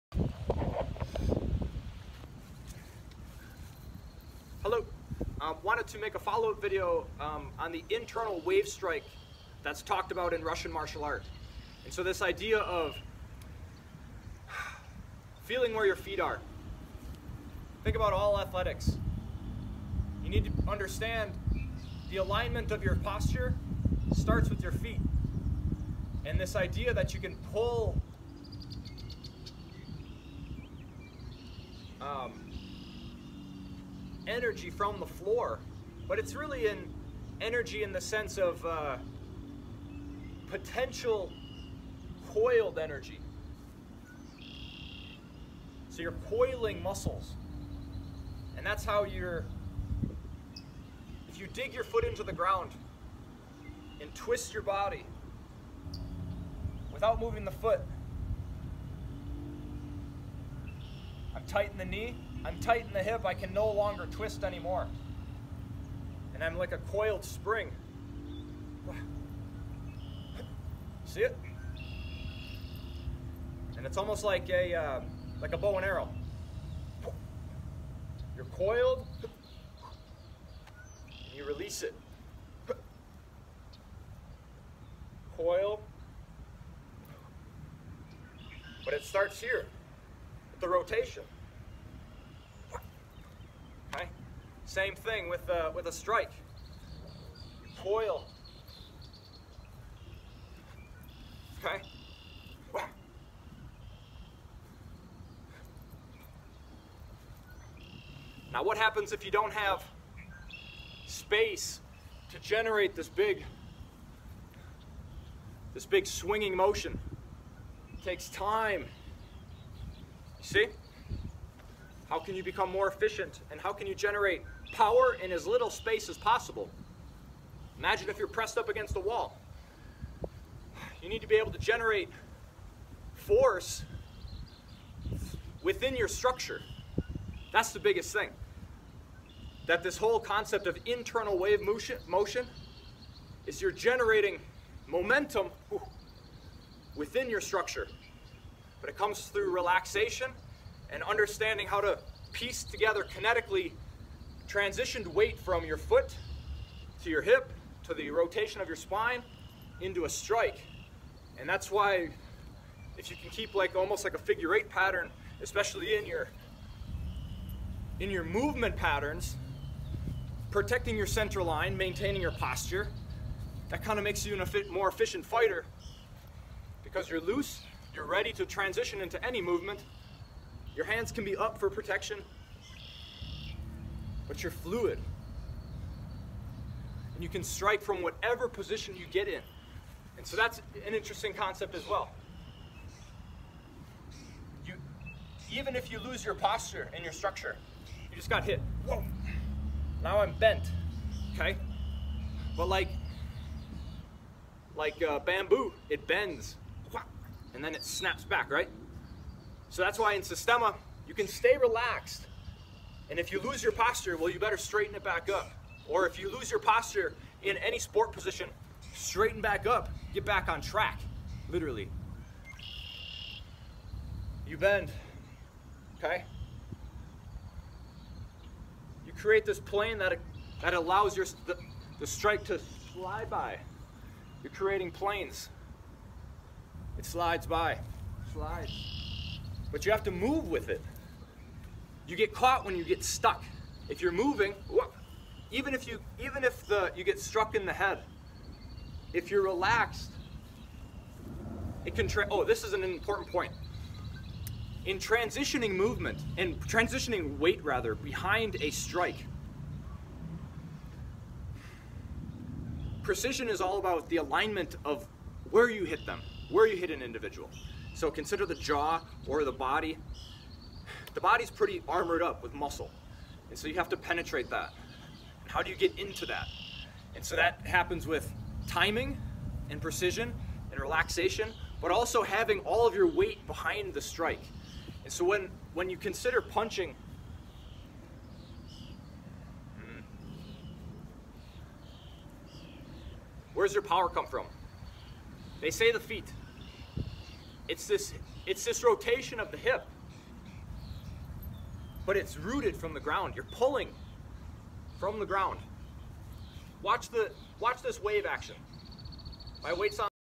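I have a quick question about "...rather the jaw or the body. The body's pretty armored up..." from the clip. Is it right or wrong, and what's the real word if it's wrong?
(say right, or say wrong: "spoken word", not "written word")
wrong: "consider", not "rather".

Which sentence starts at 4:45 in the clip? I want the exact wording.
And so when, when you consider punching, where's your power come from?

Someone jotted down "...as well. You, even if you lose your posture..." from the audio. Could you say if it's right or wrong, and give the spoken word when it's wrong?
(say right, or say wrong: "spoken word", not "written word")
right.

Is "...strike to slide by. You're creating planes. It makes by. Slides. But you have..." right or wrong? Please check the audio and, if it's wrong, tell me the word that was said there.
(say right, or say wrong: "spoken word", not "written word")
wrong: "slides", not "makes".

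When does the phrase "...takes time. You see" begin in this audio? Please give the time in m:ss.
1:58.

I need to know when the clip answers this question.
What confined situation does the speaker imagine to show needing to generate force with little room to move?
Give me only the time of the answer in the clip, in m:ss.
2:08.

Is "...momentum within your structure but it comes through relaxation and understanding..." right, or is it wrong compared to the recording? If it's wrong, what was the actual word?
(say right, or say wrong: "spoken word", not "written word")
right.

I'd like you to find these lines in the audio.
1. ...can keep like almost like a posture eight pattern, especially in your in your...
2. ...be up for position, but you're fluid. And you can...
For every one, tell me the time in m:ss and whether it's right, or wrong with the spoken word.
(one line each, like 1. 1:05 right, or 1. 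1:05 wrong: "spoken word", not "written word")
1. 2:43 wrong: "figure", not "posture"
2. 3:01 wrong: "protection", not "position".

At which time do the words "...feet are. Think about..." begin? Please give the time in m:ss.
0:15.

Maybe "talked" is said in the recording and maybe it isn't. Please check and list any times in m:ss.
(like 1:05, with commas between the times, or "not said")
0:09.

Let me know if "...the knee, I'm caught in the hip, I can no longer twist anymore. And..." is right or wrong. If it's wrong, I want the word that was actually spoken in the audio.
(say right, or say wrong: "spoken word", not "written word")
wrong: "tight", not "caught".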